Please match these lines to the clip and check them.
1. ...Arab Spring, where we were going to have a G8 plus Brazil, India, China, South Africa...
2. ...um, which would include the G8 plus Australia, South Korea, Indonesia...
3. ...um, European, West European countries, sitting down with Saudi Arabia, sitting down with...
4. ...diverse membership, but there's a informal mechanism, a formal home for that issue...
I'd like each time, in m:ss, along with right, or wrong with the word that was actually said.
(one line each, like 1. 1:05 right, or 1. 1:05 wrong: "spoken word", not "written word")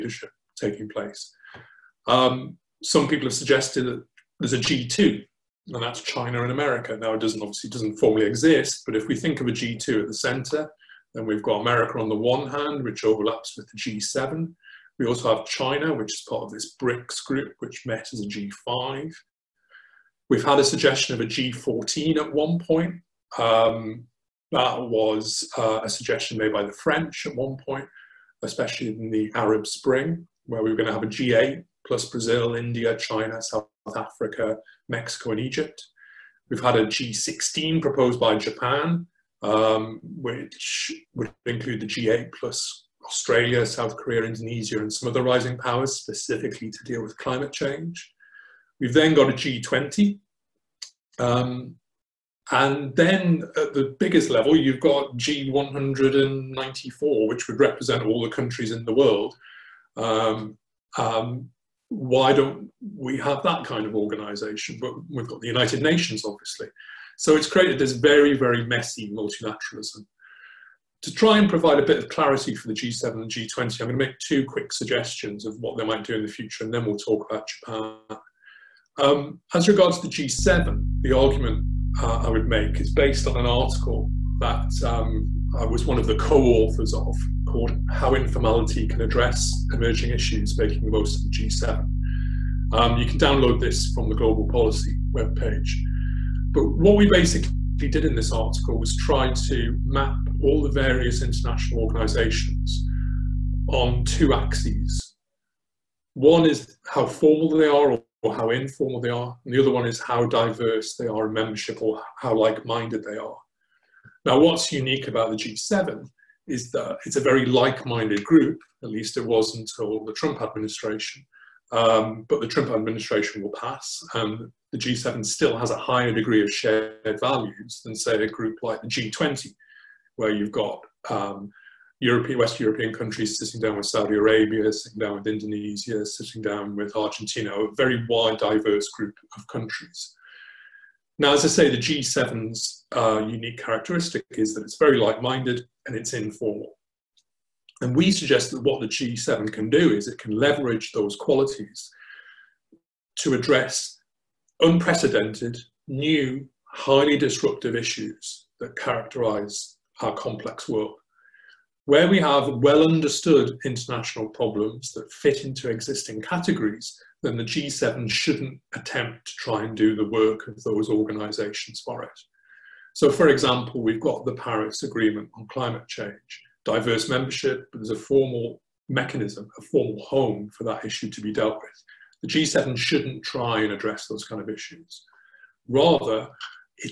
1. 0:29 right
2. 0:39 right
3. 2:11 right
4. 2:56 wrong: "formal", not "informal".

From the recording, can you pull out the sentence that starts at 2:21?
Now, as I say, the G7's uh, unique characteristic is that it's very like minded and it's informal.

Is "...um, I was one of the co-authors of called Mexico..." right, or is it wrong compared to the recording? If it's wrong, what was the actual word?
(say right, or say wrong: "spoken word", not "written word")
wrong: "How", not "Mexico".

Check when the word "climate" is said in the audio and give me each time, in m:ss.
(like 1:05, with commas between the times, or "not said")
0:47, 2:55.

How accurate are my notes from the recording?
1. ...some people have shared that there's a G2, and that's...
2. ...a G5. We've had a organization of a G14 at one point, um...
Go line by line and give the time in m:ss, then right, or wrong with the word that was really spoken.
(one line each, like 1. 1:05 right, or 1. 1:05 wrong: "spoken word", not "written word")
1. 0:02 wrong: "suggested", not "shared"
2. 0:18 wrong: "suggestion", not "organization".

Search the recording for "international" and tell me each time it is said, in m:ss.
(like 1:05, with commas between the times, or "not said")
1:41, 2:43.